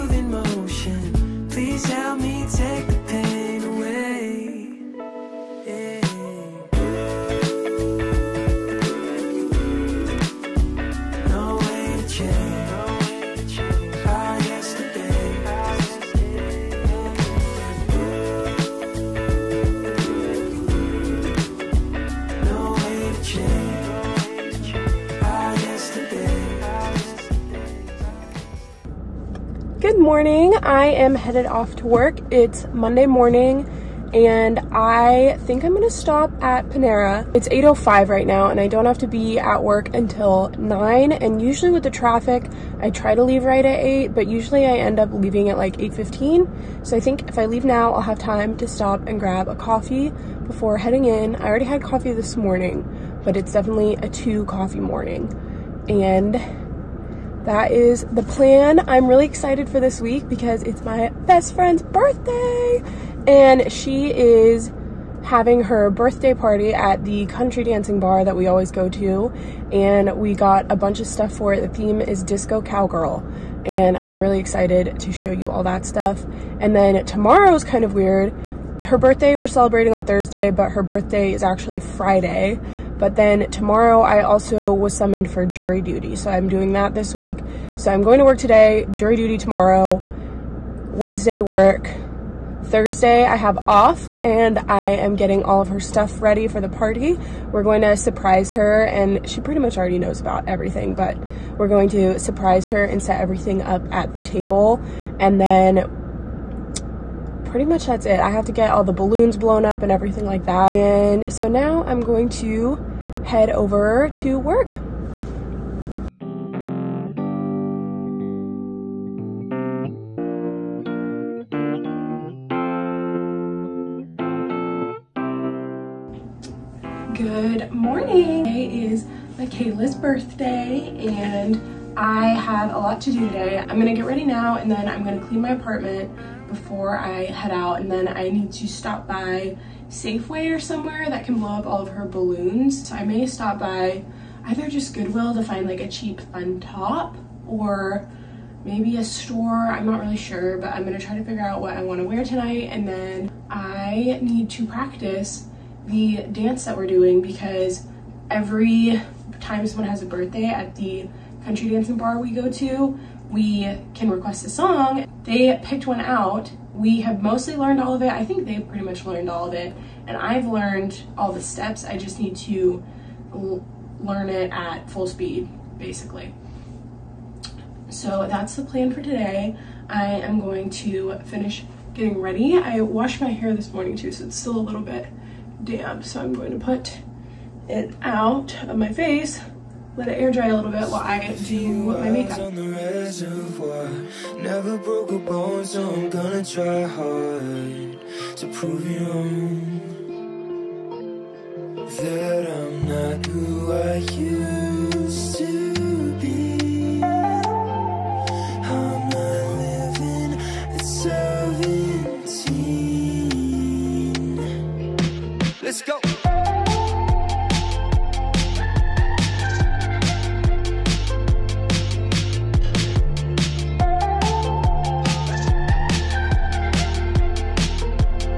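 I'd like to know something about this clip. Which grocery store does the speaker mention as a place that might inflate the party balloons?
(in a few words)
Safeway.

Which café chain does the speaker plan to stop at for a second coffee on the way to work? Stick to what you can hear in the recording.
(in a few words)
Panera.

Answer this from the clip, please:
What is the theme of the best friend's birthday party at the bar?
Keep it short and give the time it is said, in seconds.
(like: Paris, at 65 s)
disco cowgirl, at 72 s.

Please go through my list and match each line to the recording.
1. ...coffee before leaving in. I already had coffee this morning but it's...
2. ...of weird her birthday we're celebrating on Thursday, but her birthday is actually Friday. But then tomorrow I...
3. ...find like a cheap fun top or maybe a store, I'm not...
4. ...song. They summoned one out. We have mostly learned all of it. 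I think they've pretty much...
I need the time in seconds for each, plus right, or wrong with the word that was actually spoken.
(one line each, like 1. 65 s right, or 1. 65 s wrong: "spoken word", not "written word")
1. 49 s wrong: "heading", not "leaving"
2. 77 s right
3. 145 s right
4. 164 s wrong: "picked", not "summoned".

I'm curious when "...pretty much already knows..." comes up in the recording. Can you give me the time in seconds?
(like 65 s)
99 s.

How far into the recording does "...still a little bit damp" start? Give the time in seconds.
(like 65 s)
184 s.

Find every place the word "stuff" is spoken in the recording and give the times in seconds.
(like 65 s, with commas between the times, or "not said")
71 s, 75 s, 95 s.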